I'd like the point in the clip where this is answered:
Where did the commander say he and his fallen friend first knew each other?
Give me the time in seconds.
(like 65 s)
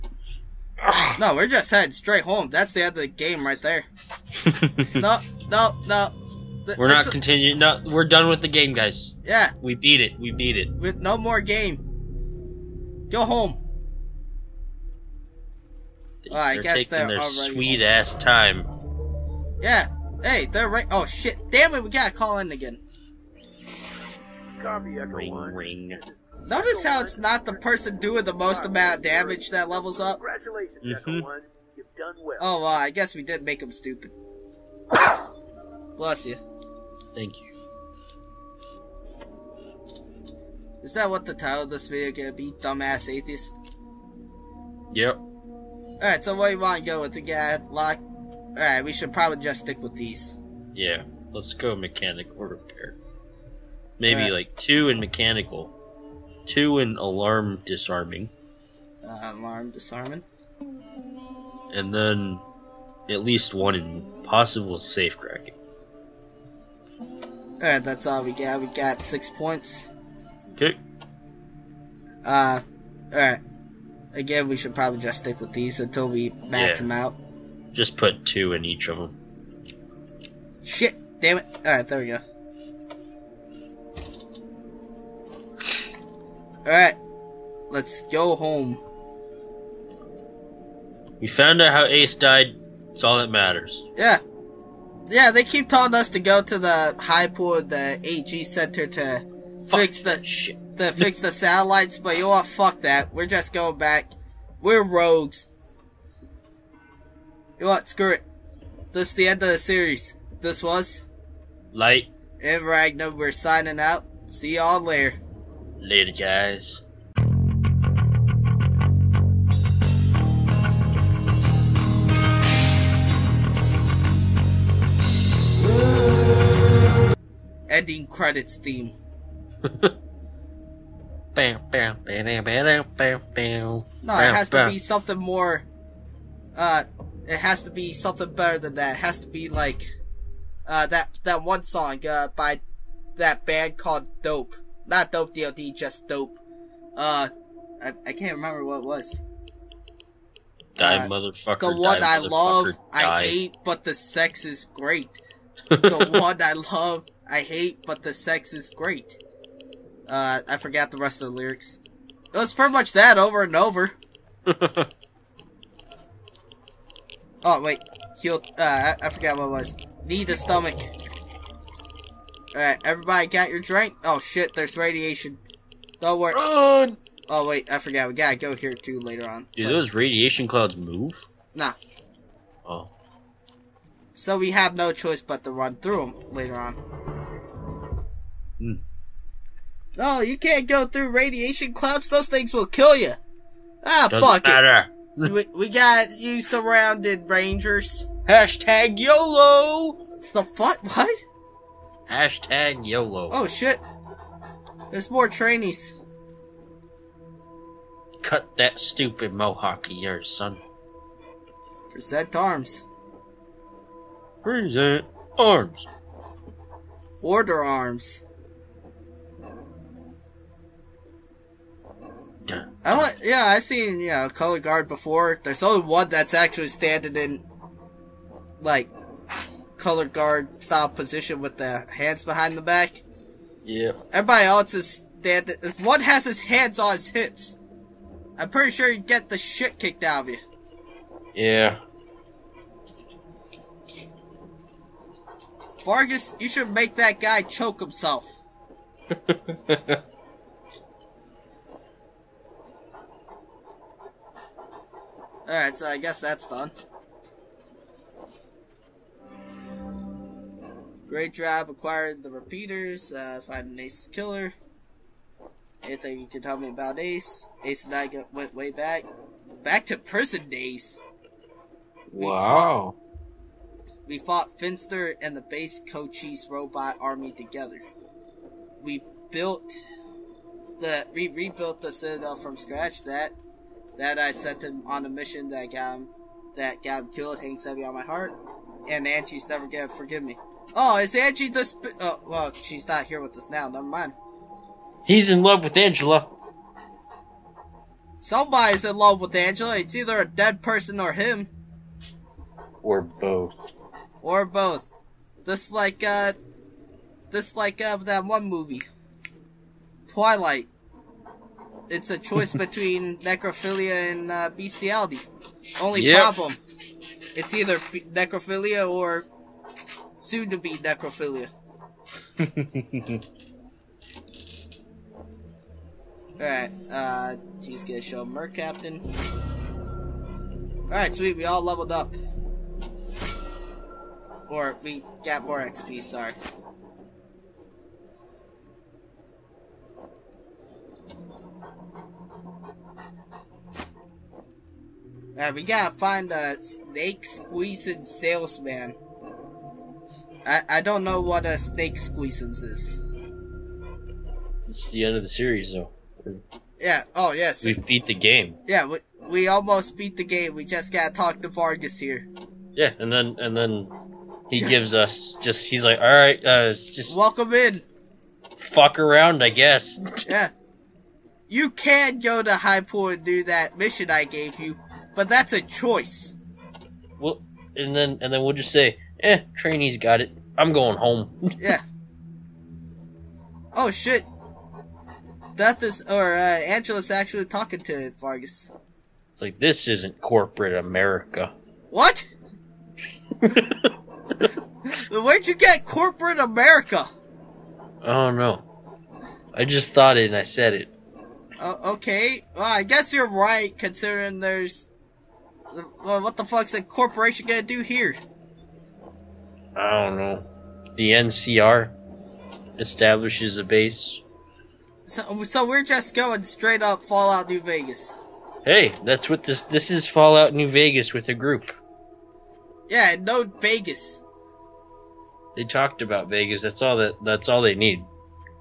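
269 s.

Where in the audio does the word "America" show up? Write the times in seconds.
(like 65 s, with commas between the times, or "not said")
390 s, 396 s.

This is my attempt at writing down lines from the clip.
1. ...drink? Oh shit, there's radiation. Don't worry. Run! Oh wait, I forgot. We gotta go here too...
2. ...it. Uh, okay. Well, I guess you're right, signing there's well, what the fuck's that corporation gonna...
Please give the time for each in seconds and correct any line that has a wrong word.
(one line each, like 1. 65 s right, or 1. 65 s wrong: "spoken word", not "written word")
1. 173 s right
2. 400 s wrong: "considering", not "signing".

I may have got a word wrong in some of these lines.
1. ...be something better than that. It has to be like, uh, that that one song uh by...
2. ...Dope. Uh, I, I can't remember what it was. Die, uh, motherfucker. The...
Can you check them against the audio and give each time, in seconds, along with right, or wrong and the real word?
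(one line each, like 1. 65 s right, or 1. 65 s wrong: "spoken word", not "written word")
1. 137 s right
2. 146 s right.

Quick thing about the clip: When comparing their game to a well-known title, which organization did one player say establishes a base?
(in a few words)
NCR.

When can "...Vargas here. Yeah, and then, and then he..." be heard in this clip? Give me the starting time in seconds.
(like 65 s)
361 s.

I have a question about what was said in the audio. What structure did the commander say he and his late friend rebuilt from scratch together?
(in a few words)
The Citadel.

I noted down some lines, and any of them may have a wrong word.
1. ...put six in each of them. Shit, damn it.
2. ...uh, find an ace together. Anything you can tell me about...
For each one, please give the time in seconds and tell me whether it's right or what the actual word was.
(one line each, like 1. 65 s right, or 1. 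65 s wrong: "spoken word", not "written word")
1. 77 s wrong: "two", not "six"
2. 263 s wrong: "killer", not "together".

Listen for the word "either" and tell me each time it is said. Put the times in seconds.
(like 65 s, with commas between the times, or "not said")
299 s, 317 s.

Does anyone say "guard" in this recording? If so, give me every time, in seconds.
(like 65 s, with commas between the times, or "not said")
224 s, 230 s.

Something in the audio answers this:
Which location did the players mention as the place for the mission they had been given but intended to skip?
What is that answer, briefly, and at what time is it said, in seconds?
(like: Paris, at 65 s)
High Point, at 372 s.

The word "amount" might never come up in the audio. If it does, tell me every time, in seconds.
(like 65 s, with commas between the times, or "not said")
28 s.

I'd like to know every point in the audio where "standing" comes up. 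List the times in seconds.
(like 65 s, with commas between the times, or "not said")
226 s, 235 s.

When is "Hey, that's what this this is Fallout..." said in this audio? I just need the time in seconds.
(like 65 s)
418 s.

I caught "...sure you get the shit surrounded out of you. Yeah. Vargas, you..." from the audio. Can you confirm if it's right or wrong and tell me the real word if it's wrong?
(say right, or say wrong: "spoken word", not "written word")
wrong: "kicked", not "surrounded".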